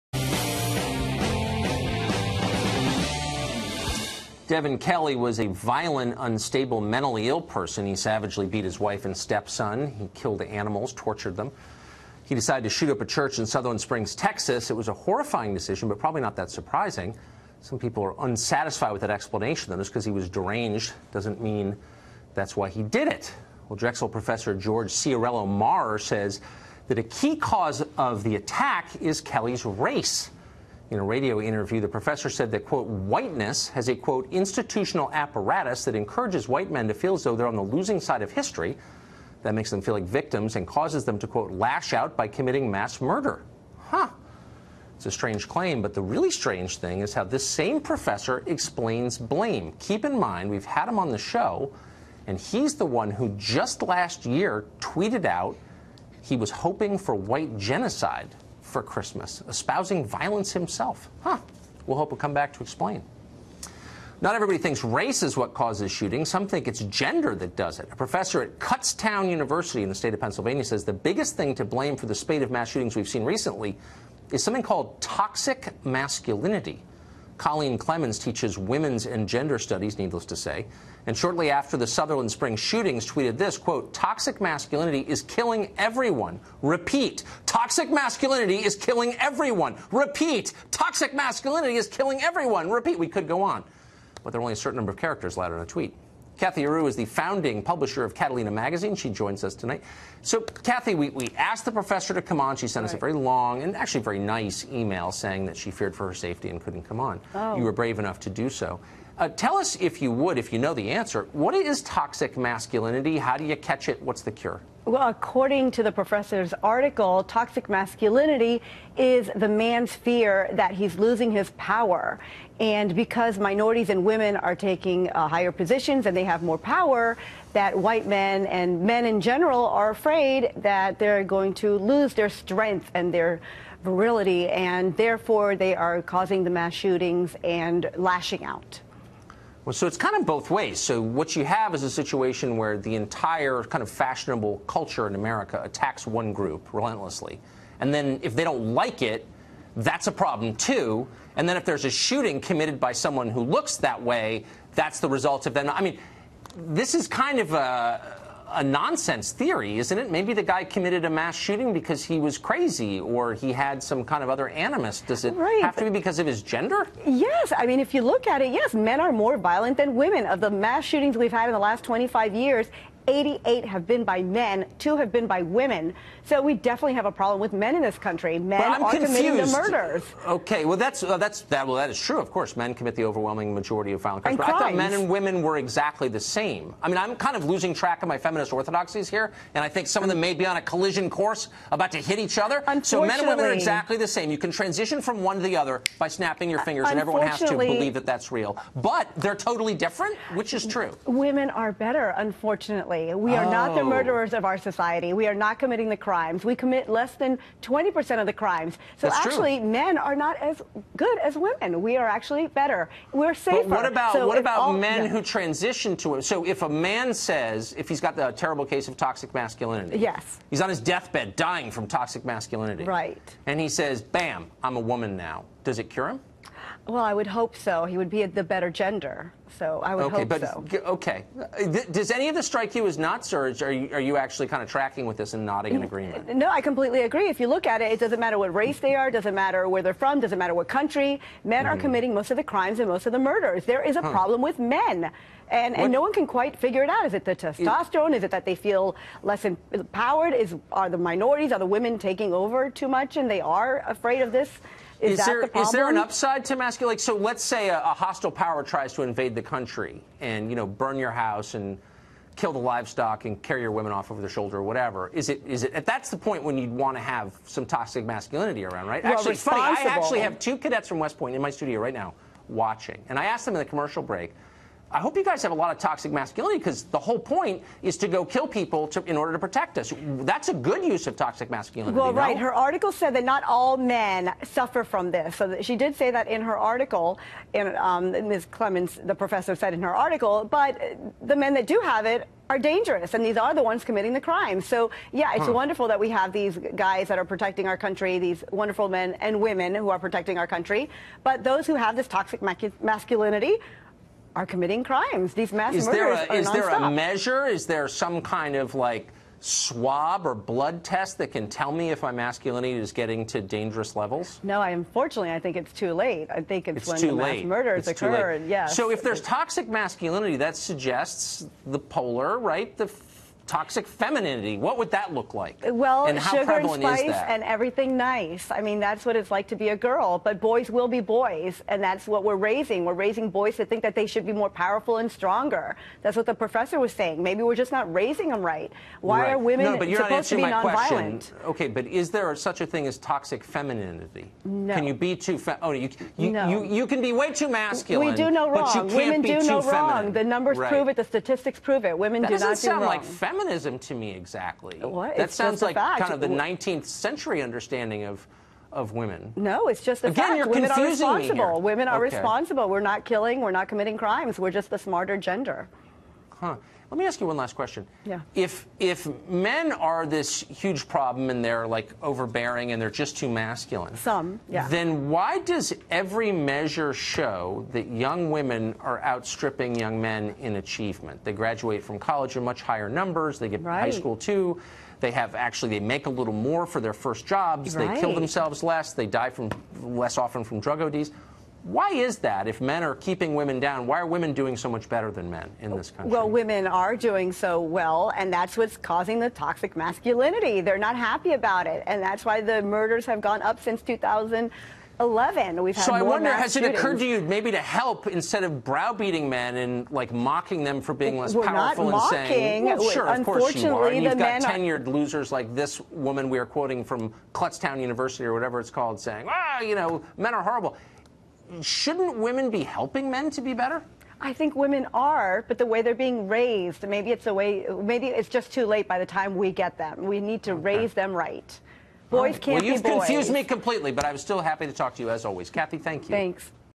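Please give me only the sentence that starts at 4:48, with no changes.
Clemens, the professor, said in her article.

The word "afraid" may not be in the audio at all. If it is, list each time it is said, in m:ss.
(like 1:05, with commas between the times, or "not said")
2:09, 4:13.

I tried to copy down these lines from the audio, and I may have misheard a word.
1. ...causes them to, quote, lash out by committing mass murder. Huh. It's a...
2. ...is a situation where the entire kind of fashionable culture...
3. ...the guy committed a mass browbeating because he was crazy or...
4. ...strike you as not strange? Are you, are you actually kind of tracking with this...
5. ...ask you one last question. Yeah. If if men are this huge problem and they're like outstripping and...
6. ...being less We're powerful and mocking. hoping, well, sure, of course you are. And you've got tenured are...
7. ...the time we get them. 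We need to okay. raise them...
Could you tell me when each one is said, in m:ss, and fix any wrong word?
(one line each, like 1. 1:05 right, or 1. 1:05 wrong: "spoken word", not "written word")
1. 0:40 right
2. 2:21 right
3. 2:40 wrong: "shooting", not "browbeating"
4. 3:52 wrong: "surge", not "strange"
5. 6:07 wrong: "overbearing", not "outstripping"
6. 6:50 wrong: "saying", not "hoping"
7. 7:08 right.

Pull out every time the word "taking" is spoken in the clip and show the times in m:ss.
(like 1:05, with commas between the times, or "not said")
2:04, 4:11.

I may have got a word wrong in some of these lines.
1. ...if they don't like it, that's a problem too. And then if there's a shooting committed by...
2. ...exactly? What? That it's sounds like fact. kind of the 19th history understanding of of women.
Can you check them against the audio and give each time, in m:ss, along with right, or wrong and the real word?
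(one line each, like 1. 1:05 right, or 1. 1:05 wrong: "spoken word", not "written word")
1. 2:28 right
2. 5:54 wrong: "century", not "history".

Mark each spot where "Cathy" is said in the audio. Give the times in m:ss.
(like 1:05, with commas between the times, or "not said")
1:36, 7:15.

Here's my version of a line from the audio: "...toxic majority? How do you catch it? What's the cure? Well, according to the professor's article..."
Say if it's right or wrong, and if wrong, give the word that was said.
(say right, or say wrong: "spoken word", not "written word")
wrong: "masculinity", not "majority".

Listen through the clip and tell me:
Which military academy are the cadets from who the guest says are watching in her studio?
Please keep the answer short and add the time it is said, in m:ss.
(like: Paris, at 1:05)
West Point, at 4:30.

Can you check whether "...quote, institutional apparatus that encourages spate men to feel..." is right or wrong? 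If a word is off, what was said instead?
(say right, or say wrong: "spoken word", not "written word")
wrong: "white", not "spate".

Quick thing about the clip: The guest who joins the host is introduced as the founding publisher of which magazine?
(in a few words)
Catalina Magazine.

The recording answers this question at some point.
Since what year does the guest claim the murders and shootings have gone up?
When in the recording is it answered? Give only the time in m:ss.
6:43.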